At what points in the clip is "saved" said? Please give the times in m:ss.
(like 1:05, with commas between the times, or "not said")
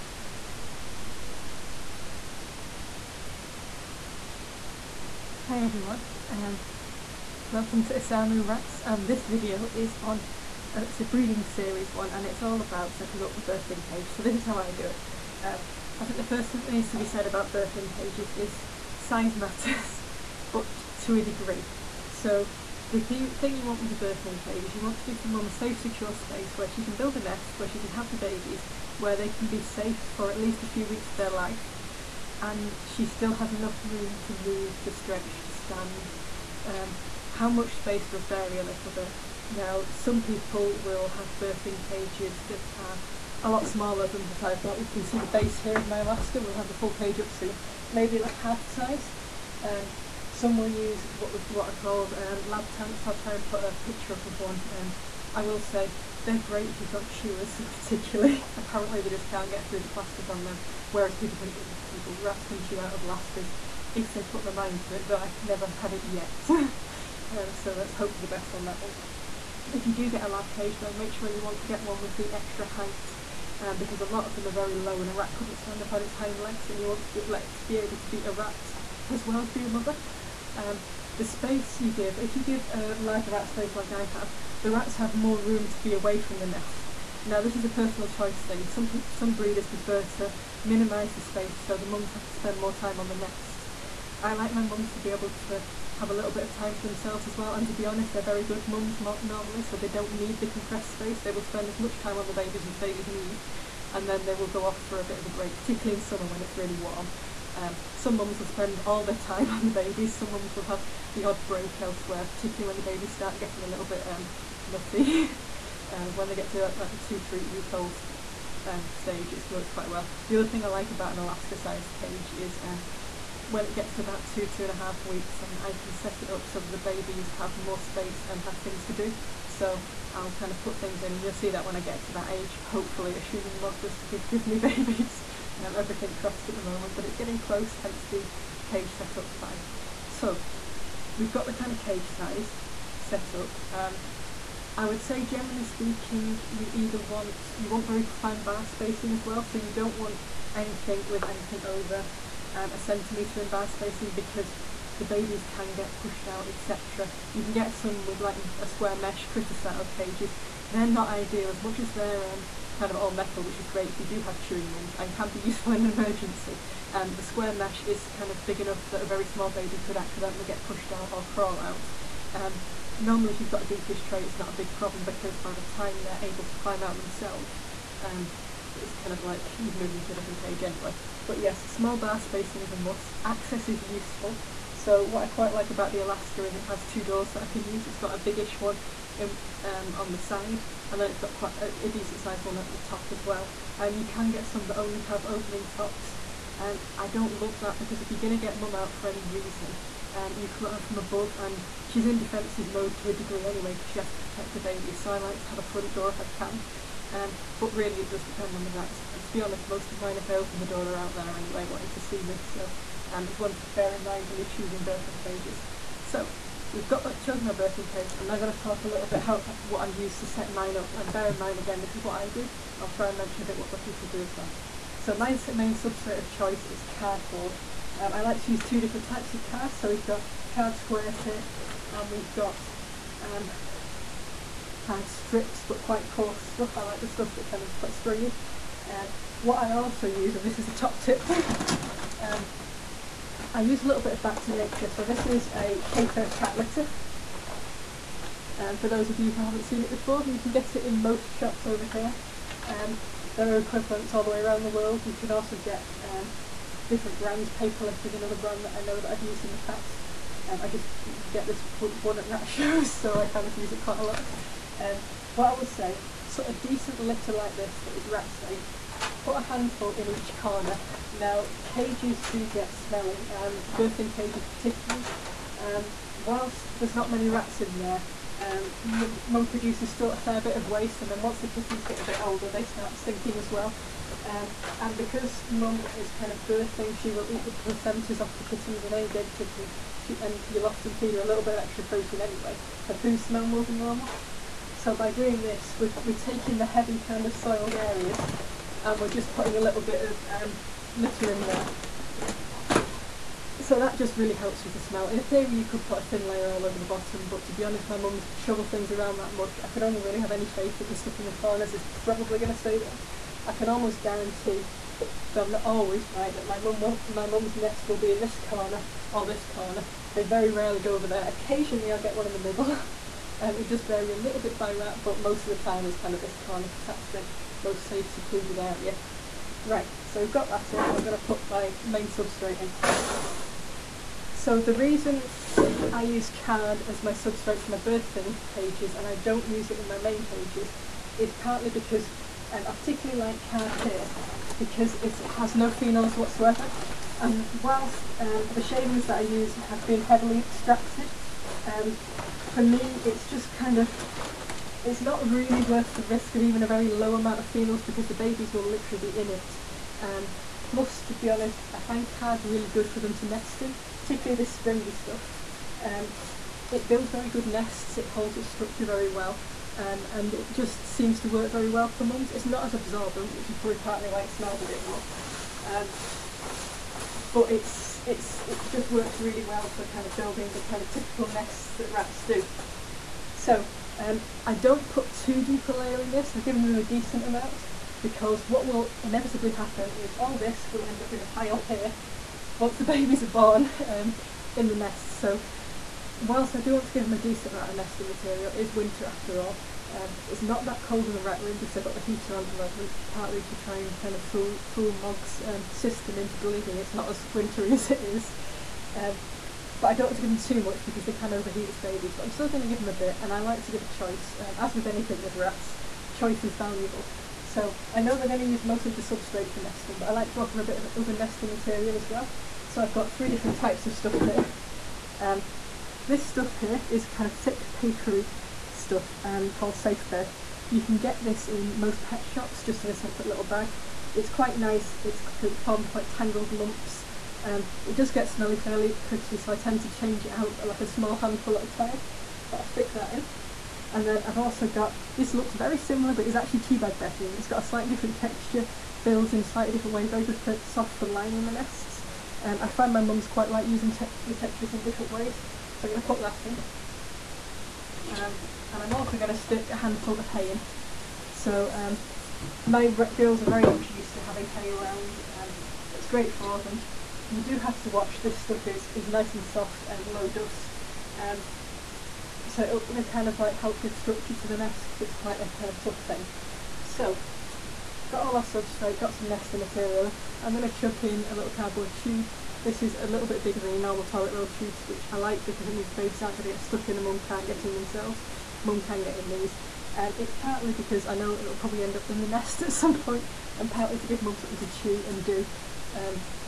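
not said.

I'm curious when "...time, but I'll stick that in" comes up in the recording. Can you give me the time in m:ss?
7:21.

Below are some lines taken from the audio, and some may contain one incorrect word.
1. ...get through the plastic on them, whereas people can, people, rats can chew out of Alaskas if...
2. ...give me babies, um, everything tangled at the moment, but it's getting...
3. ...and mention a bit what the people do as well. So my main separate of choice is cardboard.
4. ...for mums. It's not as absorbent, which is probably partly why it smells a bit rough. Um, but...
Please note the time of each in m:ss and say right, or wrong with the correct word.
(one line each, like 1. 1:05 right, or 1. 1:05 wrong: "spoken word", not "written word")
1. 0:59 right
2. 2:14 wrong: "crossed", not "tangled"
3. 3:43 wrong: "substrate", not "separate"
4. 6:11 right.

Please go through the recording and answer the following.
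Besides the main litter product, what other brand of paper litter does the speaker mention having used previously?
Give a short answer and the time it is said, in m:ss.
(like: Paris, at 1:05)
Paperless, at 4:17.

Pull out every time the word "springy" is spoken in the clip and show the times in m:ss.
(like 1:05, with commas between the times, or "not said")
3:57, 6:04.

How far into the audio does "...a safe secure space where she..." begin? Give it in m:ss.
0:25.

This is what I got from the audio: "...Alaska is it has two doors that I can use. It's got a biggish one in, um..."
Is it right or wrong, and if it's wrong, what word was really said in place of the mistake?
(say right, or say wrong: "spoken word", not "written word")
right.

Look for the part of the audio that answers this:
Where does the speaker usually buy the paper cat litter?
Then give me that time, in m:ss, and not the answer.
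4:22.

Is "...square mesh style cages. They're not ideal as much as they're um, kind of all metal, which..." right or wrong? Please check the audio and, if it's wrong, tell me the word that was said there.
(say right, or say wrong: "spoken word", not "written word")
right.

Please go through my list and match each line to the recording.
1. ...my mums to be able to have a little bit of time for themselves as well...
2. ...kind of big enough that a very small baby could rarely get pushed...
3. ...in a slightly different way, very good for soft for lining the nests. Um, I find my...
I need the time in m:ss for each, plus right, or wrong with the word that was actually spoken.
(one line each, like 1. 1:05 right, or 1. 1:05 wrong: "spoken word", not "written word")
1. 1:34 right
2. 2:48 wrong: "accidentally", not "rarely"
3. 7:29 right.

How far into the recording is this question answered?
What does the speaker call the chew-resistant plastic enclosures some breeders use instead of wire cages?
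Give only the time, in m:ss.
0:52.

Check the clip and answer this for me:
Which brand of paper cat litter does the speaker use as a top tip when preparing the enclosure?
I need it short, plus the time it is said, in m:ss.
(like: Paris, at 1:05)
Back to Nature, at 4:04.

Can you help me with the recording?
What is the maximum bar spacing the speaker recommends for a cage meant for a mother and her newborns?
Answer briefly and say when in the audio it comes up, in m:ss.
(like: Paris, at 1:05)
a centimetre, at 2:32.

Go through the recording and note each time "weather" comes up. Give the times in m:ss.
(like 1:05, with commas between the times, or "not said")
not said.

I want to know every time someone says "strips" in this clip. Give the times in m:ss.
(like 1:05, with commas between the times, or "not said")
3:55.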